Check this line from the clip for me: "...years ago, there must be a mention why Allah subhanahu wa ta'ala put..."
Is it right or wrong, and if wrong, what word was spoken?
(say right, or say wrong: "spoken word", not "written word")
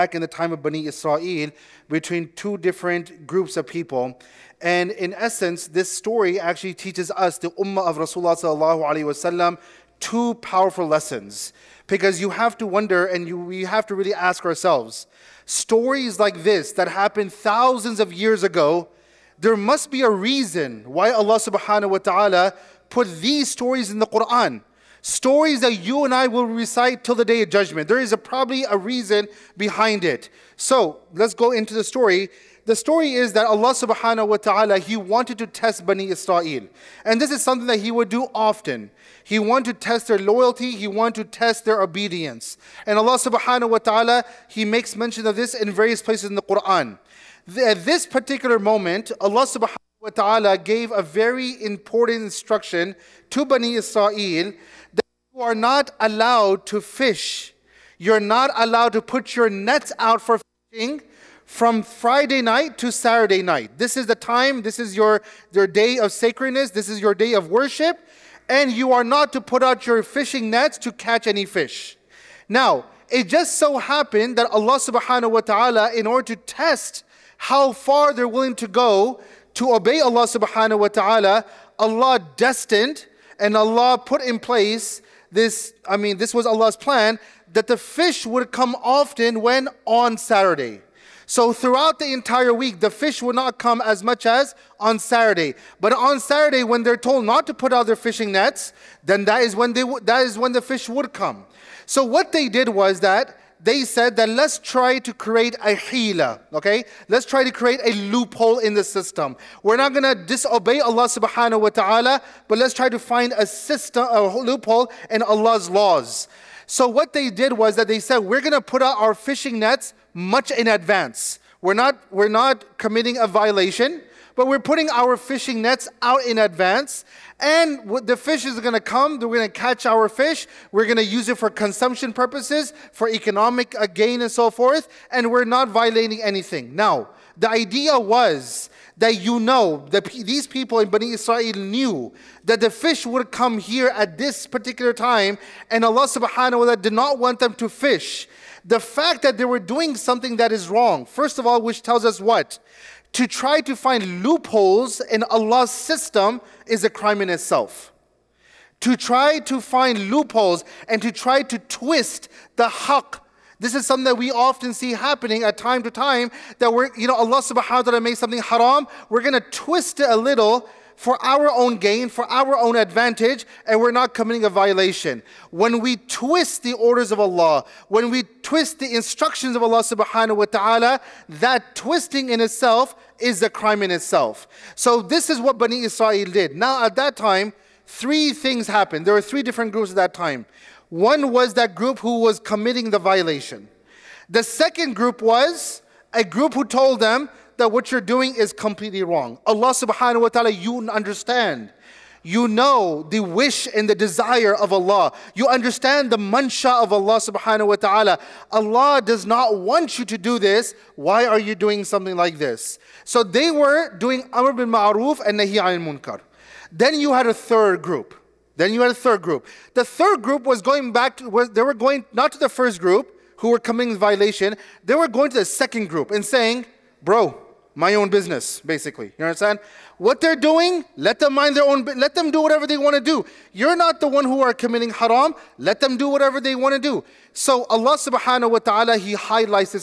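wrong: "reason", not "mention".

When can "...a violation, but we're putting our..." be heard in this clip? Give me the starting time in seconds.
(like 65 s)
123 s.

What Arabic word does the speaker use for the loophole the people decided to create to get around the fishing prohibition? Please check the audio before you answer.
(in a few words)
hila.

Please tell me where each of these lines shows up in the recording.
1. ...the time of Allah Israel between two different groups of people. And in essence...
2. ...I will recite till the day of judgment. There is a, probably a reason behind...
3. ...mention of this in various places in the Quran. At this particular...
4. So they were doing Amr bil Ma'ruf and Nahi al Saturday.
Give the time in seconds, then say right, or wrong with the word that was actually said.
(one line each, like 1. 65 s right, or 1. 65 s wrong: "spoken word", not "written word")
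1. 0 s wrong: "Bani", not "Allah"
2. 26 s right
3. 44 s right
4. 213 s wrong: "Munkar", not "Saturday".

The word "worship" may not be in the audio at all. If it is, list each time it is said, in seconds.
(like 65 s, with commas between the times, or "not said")
67 s.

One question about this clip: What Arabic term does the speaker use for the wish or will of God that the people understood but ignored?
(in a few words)
mansha.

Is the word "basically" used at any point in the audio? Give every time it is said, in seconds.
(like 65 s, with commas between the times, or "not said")
228 s.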